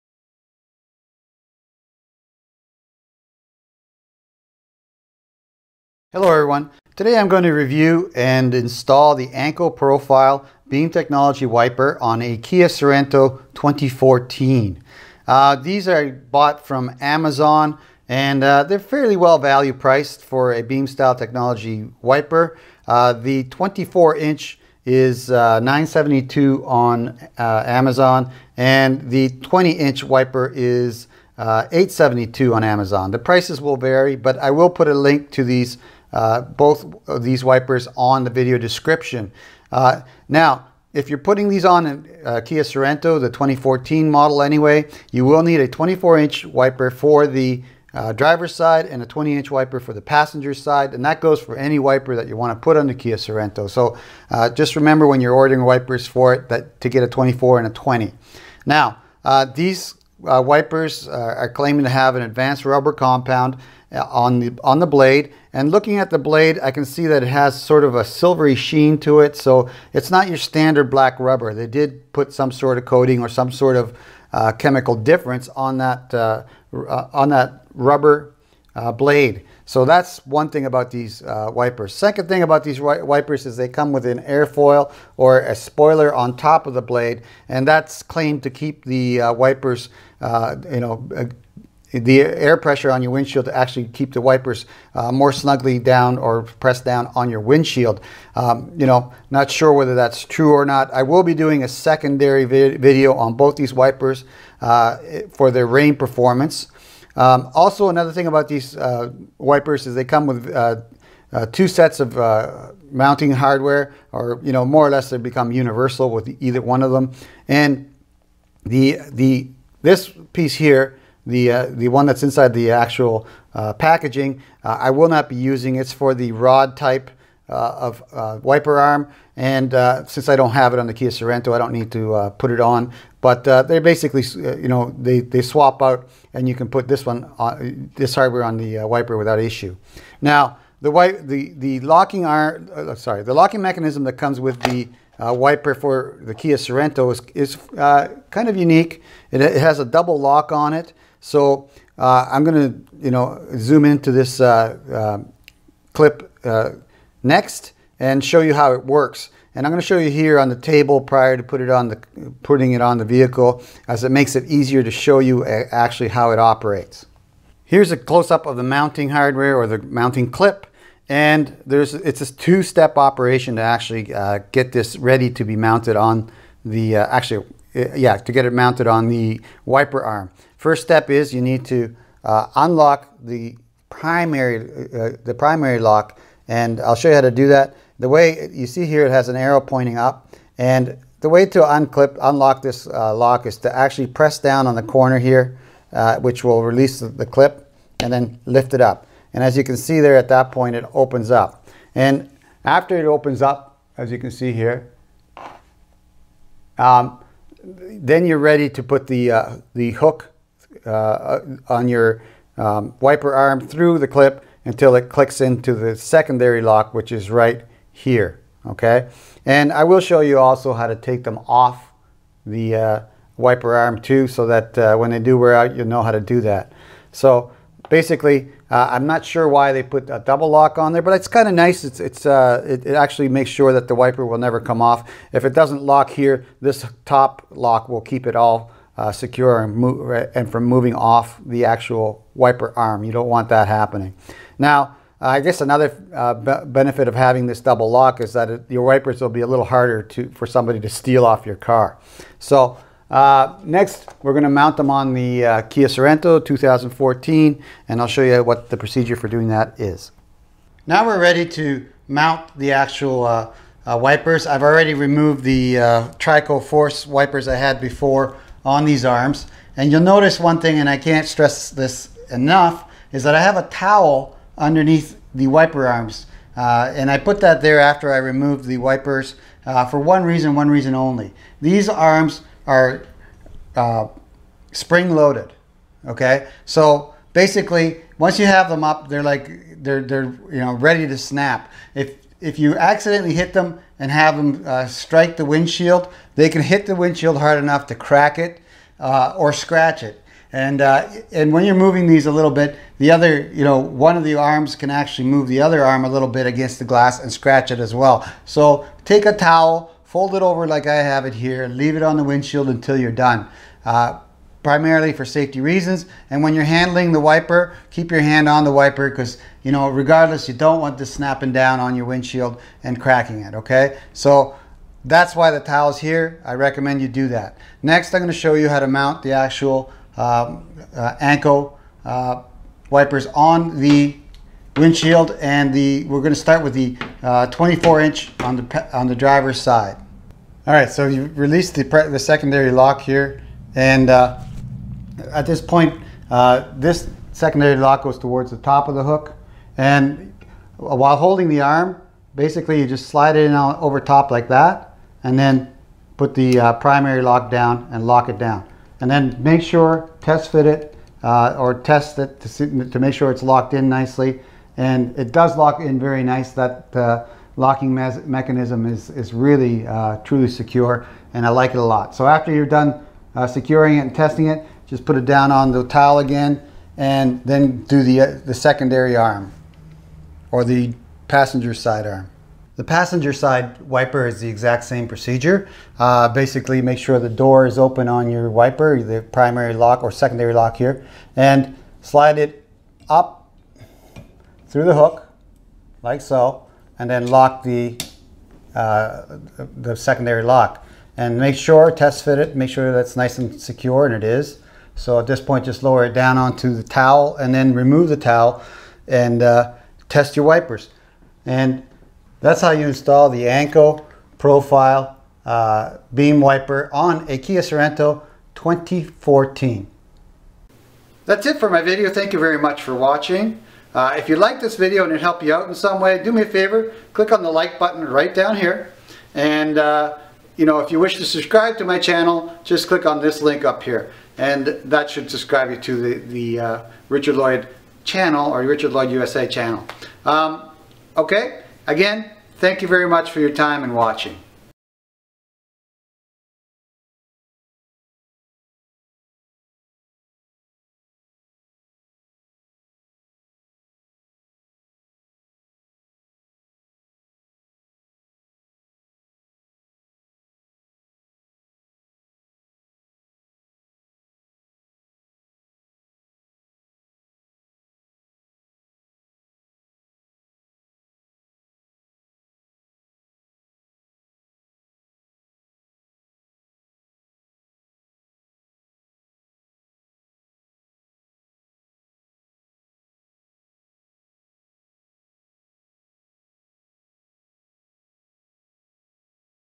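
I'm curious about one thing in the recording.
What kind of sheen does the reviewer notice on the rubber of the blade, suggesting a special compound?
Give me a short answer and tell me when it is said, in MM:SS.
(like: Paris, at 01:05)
silvery, at 01:08.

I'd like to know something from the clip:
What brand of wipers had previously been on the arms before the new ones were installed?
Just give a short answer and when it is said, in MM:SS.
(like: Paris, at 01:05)
Trico Force, at 04:26.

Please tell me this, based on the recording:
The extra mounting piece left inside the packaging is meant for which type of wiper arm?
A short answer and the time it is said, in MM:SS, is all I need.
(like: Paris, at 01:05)
rod type, at 02:06.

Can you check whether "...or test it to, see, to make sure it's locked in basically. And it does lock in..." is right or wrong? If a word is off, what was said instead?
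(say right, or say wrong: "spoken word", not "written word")
wrong: "nicely", not "basically".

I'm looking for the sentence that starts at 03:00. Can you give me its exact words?
First step is you need to uh, unlock the primary, eh, the primary lock.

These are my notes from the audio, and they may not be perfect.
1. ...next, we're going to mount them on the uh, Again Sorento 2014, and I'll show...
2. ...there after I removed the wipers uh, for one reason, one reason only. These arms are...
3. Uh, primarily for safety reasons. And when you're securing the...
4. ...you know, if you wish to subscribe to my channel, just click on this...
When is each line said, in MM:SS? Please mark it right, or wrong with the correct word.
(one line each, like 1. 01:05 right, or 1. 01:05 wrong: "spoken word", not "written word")
1. 04:13 wrong: "Kia", not "Again"
2. 04:37 right
3. 05:13 wrong: "handling", not "securing"
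4. 07:10 right.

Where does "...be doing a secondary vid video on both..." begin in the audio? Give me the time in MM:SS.
01:41.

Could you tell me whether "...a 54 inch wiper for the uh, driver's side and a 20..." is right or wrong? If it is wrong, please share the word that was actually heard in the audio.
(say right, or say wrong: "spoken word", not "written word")
wrong: "24", not "54".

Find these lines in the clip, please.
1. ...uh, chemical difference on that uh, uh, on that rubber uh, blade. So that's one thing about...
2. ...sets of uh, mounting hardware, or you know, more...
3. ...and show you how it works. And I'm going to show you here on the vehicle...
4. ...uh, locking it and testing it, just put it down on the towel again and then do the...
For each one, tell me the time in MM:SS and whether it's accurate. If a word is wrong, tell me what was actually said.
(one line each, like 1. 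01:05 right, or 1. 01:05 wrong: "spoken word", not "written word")
1. 01:14 right
2. 01:51 right
3. 02:37 wrong: "table", not "vehicle"
4. 06:13 wrong: "securing", not "locking".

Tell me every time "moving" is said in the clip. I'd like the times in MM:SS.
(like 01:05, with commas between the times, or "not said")
04:00, 05:01.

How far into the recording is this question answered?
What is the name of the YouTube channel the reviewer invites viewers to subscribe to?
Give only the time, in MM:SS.
07:18.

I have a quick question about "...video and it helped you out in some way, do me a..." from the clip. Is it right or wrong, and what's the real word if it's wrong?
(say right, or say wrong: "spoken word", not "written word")
right.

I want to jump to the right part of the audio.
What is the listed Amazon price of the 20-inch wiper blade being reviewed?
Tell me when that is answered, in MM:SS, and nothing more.
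00:31.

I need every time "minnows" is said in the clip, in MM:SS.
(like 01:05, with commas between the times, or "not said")
not said.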